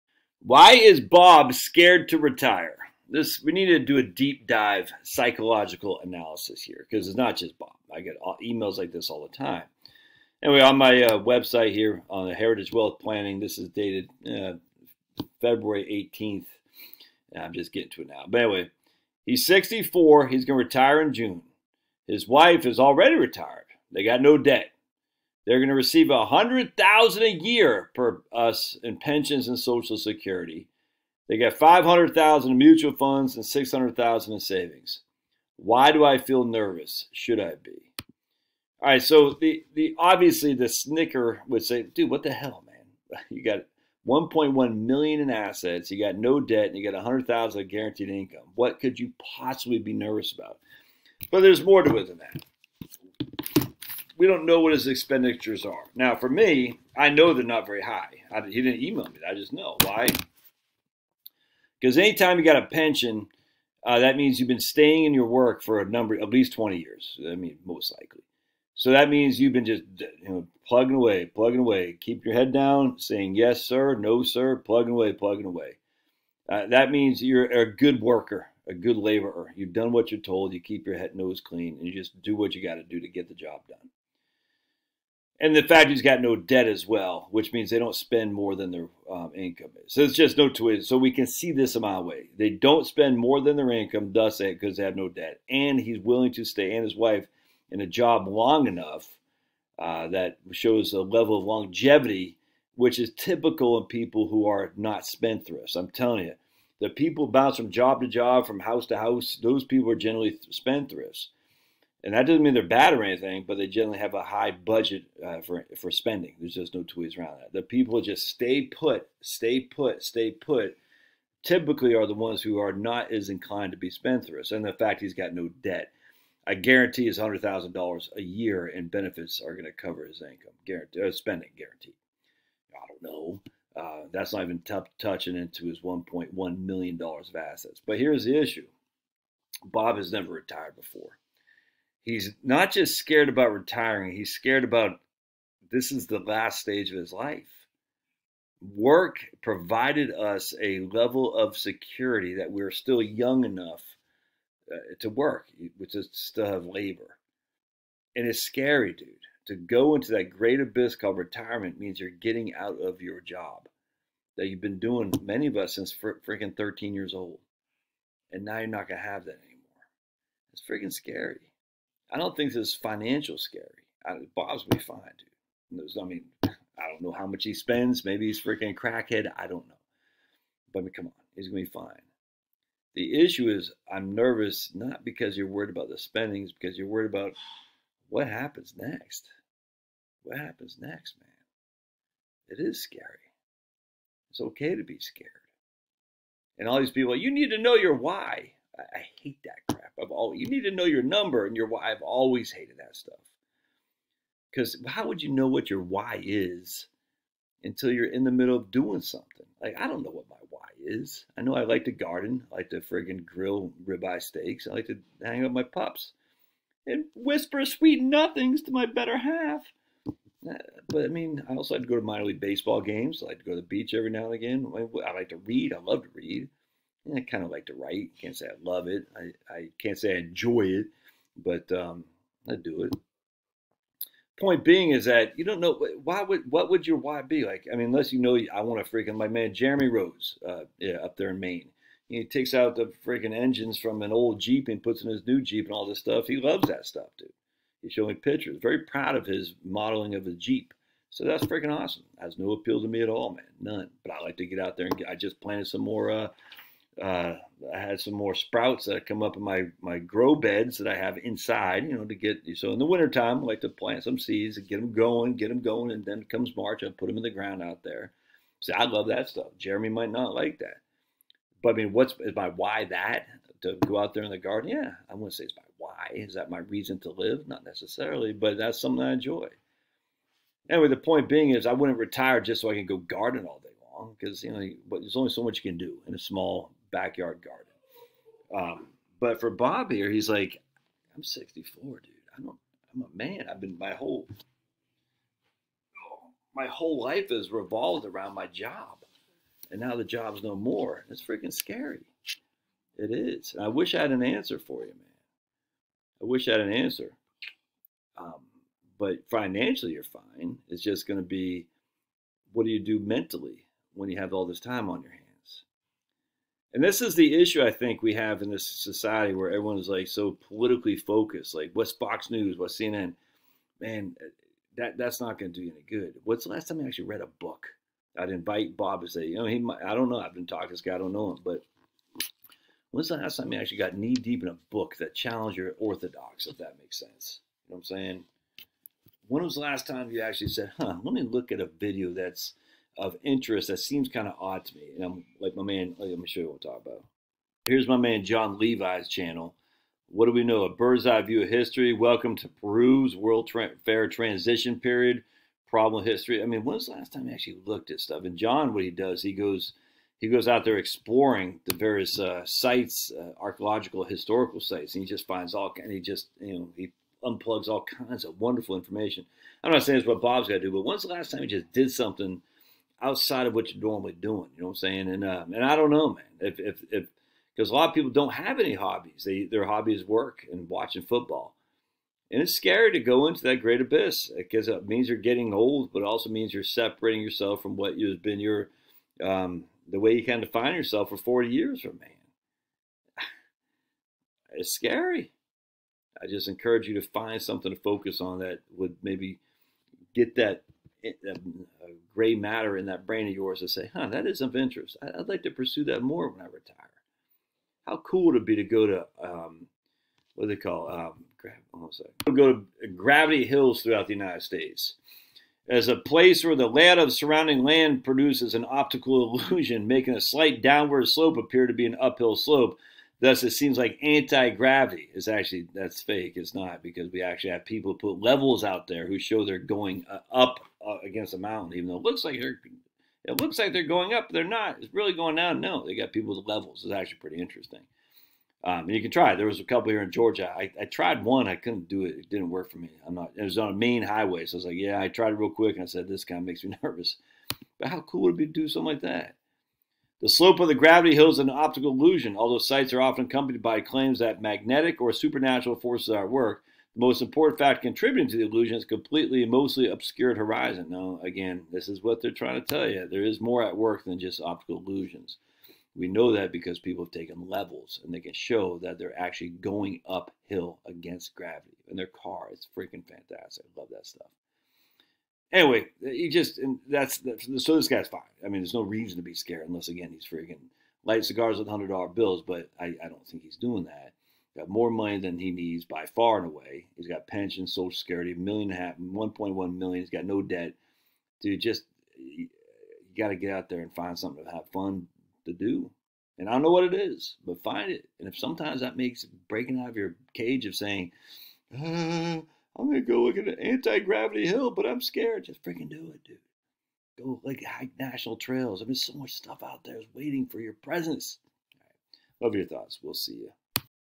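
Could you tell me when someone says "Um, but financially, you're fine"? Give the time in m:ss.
5:08.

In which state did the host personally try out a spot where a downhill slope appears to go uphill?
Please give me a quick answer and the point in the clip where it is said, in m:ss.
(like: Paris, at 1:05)
Georgia, at 7:20.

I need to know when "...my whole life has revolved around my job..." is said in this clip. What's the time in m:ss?
4:56.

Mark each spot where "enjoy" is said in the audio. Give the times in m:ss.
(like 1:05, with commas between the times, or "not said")
3:50, 4:39.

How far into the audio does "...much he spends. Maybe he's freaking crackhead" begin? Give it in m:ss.
2:57.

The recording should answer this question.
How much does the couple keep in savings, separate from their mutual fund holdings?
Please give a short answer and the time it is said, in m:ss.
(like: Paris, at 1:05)
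$600,000, at 0:33.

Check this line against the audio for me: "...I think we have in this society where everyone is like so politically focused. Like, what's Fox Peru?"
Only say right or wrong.
wrong.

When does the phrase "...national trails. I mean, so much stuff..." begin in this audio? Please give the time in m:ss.
8:27.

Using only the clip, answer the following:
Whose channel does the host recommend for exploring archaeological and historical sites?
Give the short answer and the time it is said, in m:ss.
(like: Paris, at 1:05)
Jon Levi, at 5:48.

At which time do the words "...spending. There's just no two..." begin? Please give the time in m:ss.
1:55.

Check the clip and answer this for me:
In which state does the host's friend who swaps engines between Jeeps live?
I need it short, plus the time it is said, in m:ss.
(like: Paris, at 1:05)
Maine, at 4:01.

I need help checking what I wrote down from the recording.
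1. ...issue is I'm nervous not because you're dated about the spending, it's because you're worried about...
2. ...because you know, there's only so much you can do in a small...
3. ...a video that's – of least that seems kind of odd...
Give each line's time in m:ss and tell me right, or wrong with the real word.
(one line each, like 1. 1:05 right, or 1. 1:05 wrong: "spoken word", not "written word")
1. 3:03 wrong: "worried", not "dated"
2. 4:44 right
3. 5:41 wrong: "interest", not "least".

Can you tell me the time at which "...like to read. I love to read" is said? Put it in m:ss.
3:45.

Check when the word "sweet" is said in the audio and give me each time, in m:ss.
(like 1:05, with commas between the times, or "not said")
3:37.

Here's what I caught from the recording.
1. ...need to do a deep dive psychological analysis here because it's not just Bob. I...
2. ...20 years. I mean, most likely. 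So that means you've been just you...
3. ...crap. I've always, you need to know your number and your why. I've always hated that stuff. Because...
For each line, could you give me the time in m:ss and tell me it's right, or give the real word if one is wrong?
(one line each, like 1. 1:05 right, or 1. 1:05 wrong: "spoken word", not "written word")
1. 0:03 right
2. 1:06 right
3. 3:19 right.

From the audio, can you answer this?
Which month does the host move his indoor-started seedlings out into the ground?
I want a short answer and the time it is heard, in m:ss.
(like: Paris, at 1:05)
March, at 4:26.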